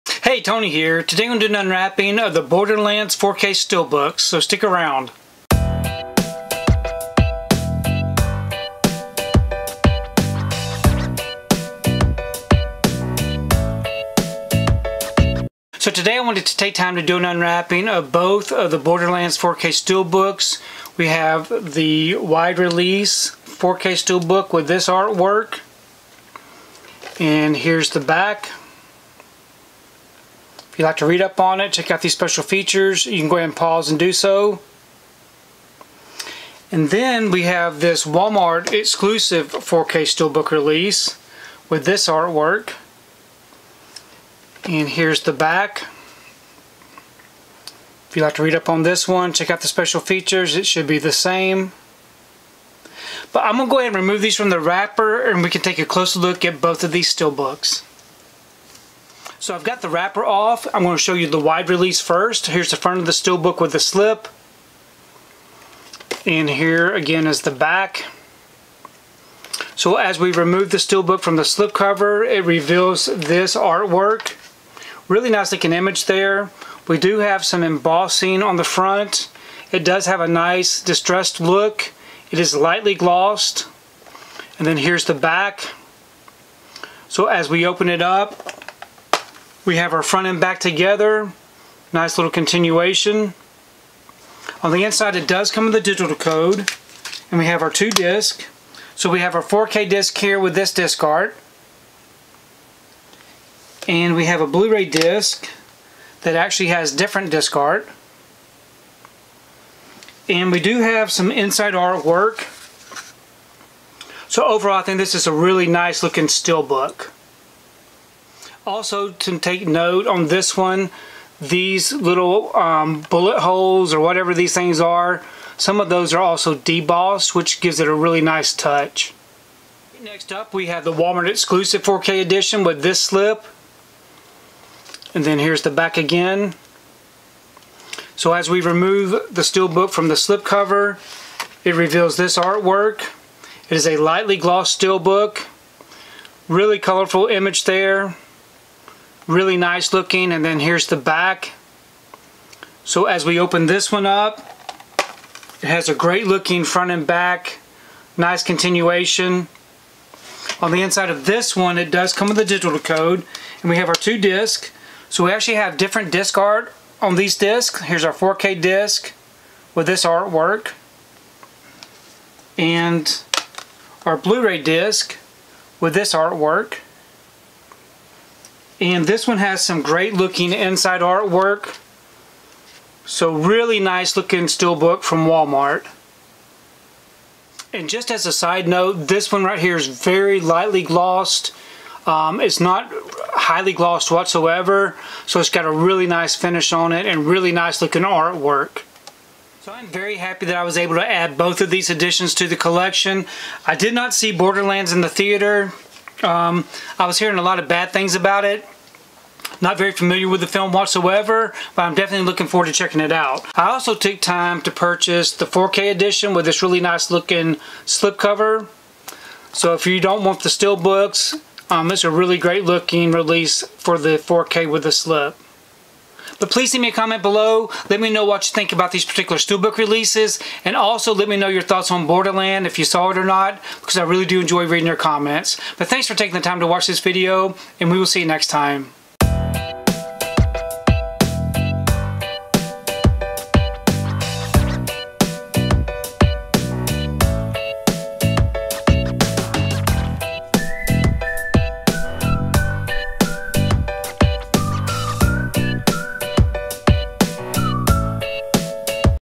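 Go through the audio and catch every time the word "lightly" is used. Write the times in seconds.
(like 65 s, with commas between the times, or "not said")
82 s, 143 s, 190 s.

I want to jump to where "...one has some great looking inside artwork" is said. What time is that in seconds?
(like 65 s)
179 s.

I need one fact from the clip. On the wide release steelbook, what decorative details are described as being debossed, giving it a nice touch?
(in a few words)
bullet holes.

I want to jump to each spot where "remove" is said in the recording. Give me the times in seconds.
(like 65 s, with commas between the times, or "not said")
54 s, 70 s, 138 s.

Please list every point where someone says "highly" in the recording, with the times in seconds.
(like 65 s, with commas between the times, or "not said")
193 s.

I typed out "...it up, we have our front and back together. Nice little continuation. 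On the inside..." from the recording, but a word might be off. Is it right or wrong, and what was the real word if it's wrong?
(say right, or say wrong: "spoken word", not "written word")
right.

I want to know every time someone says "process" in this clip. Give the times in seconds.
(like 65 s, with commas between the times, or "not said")
not said.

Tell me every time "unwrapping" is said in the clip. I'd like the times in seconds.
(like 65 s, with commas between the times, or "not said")
1 s, 17 s.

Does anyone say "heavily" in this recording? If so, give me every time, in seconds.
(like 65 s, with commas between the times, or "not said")
not said.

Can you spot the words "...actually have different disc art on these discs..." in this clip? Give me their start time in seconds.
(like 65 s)
165 s.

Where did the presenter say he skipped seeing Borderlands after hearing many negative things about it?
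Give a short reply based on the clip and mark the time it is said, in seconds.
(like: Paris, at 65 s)
the theater, at 204 s.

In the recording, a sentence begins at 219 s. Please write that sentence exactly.
So if you don't want the steel books, um, it's a really great looking release for the 4K with the slip.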